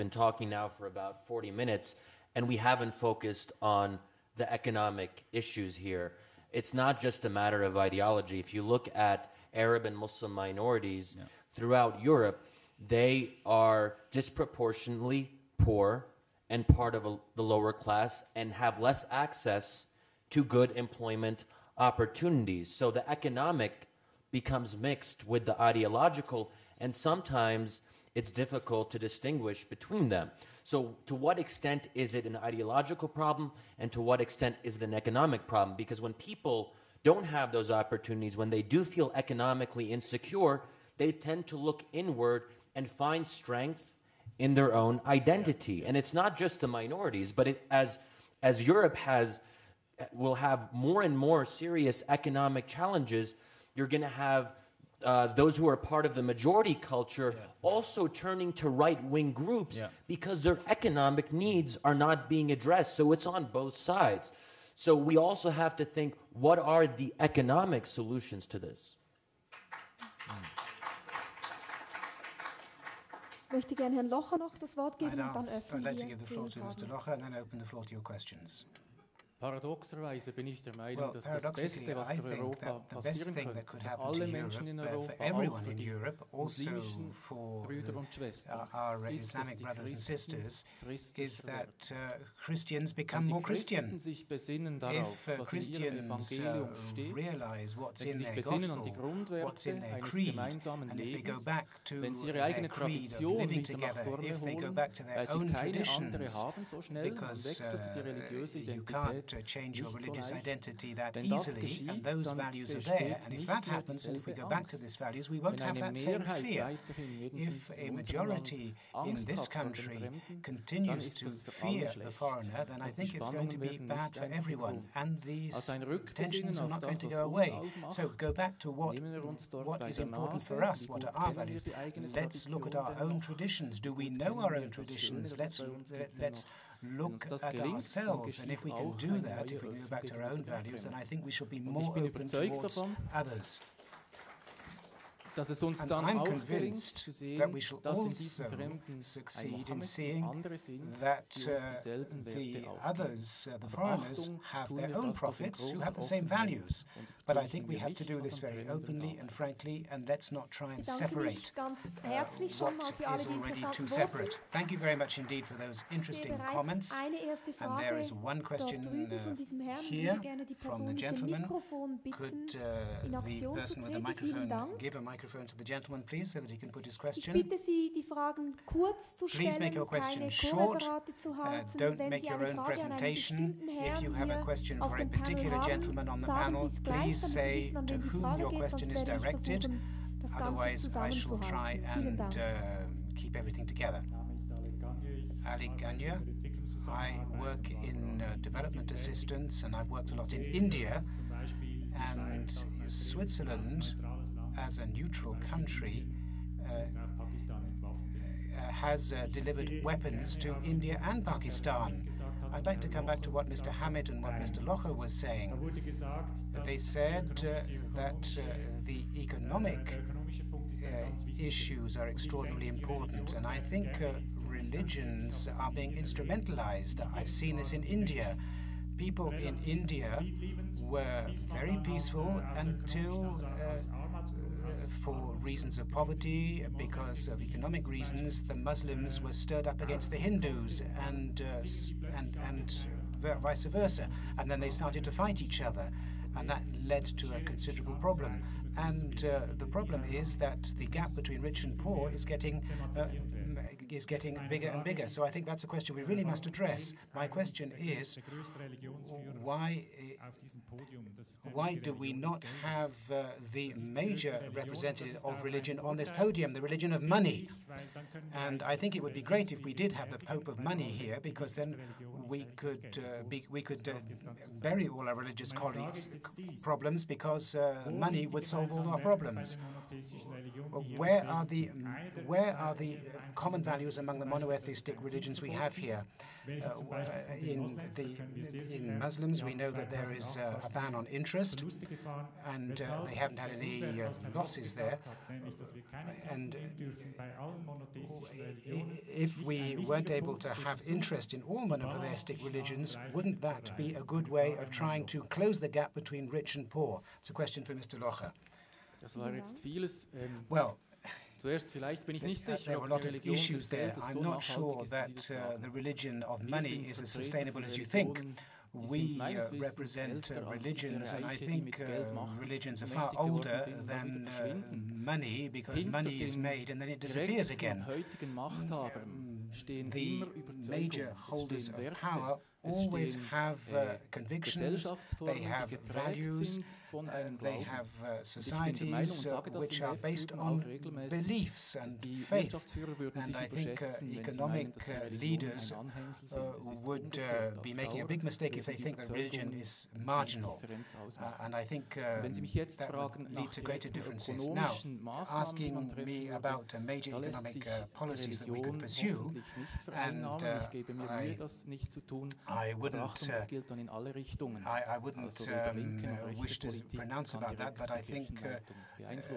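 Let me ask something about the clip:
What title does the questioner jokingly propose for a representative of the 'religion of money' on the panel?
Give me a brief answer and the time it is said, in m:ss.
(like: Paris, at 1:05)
Pope of Money, at 4:30.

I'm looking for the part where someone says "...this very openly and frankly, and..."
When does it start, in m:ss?
2:38.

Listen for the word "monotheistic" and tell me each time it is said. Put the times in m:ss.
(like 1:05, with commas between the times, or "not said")
4:44, 5:01.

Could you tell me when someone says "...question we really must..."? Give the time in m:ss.
4:15.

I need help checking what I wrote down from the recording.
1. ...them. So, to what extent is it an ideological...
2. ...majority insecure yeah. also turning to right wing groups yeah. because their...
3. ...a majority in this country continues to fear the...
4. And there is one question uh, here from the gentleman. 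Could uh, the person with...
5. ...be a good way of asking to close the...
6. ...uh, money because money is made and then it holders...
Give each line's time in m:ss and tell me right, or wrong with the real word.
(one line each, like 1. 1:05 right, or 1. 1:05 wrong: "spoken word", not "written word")
1. 0:30 right
2. 0:56 wrong: "culture", not "insecure"
3. 1:57 right
4. 2:47 right
5. 5:03 wrong: "trying", not "asking"
6. 5:24 wrong: "disappears", not "holders".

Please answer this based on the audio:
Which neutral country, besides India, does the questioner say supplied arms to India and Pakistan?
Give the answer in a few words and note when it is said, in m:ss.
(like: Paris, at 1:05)
Switzerland, at 3:22.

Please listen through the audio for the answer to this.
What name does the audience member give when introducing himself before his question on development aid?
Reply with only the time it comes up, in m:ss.
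3:15.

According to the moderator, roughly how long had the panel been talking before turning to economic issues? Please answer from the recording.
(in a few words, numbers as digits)
40 minutes.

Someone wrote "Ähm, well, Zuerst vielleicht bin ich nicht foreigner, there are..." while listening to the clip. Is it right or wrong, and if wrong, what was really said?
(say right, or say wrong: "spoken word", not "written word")
wrong: "sicher", not "foreigner".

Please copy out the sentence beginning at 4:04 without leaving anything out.
And then they started to fight each other, and that led to a considerable problem.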